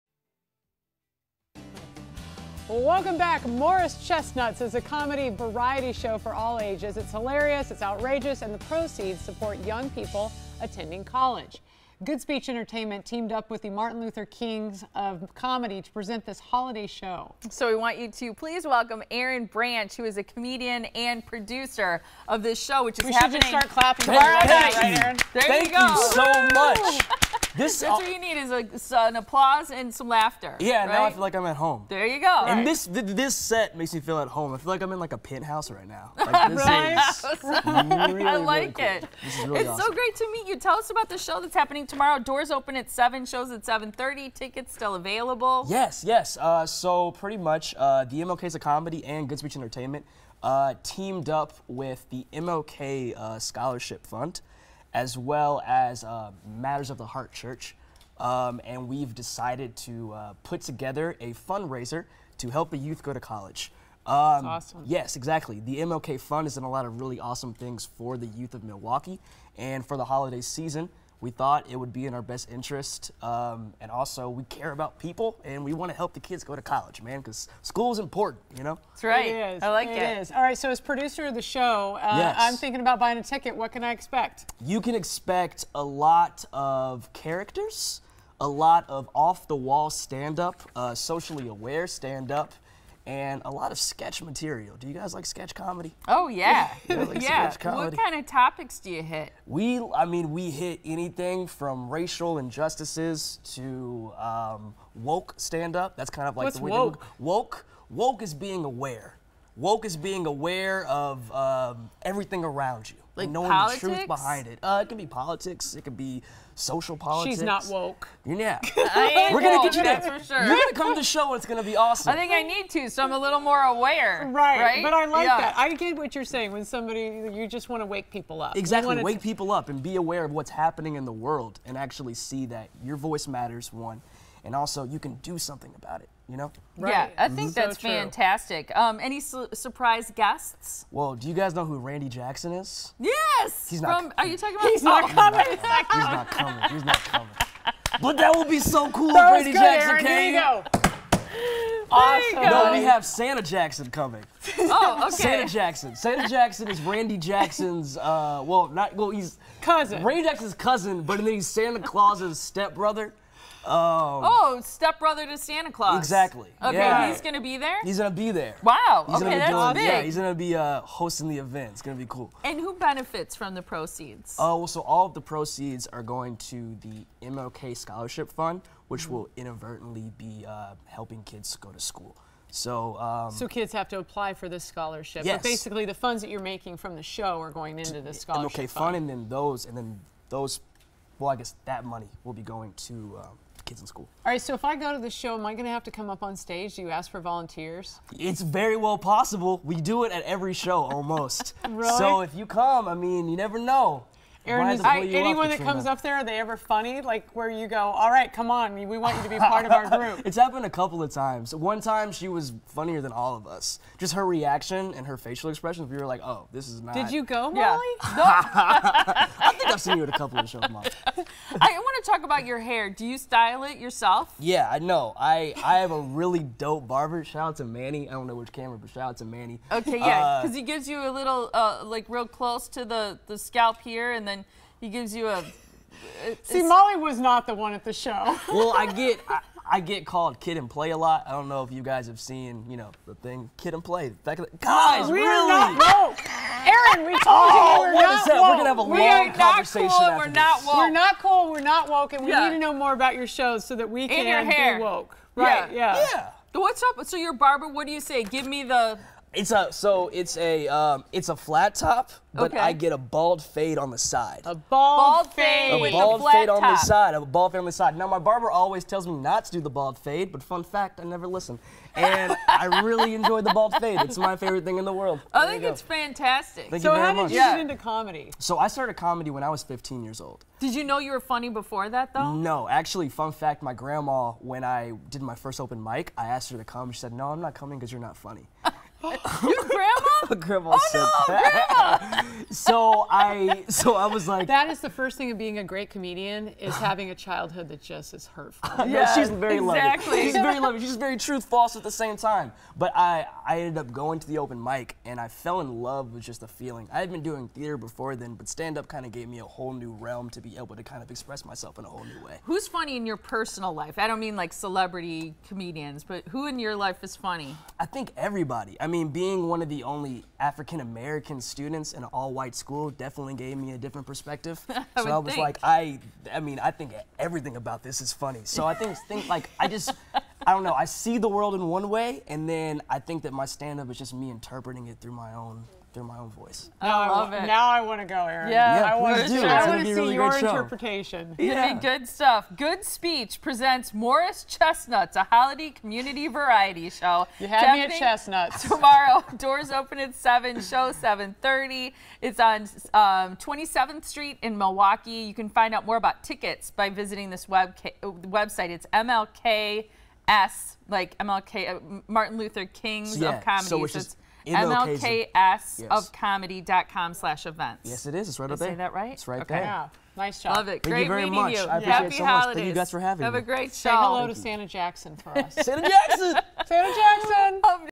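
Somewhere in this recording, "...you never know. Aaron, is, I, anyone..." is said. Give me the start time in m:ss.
3:23.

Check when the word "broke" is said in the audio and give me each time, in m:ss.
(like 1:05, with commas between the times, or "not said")
not said.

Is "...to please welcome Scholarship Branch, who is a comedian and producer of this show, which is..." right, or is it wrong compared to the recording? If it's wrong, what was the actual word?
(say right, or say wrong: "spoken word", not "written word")
wrong: "Aaron", not "Scholarship".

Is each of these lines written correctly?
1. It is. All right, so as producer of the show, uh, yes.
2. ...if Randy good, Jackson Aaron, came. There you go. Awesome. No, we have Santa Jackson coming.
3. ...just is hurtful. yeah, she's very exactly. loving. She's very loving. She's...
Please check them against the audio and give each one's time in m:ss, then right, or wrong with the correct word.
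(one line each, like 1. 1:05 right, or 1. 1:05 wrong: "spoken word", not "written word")
1. 1:19 right
2. 2:29 right
3. 4:57 right.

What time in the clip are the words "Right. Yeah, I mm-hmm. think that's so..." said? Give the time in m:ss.
2:16.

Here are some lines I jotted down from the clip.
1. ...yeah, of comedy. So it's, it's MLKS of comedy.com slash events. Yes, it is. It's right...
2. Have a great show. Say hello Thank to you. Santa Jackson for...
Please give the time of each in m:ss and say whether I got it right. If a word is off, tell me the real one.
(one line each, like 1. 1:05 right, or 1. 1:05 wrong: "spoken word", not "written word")
1. 6:03 right
2. 6:13 right.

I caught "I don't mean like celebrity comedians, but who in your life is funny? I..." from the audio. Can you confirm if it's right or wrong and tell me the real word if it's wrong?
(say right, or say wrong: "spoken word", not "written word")
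right.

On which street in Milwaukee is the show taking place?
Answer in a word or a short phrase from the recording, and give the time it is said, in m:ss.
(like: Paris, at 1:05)
27th Street, at 5:53.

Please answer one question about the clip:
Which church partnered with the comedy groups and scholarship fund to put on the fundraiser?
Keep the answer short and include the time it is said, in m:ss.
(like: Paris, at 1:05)
Matters of the Heart Church, at 0:56.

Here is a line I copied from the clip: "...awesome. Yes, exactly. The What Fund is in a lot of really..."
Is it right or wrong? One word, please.
wrong.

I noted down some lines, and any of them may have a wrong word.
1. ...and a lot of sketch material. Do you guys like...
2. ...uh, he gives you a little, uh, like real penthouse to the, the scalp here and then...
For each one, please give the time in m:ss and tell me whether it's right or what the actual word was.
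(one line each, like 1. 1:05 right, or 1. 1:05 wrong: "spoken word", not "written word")
1. 1:33 right
2. 3:50 wrong: "close", not "penthouse".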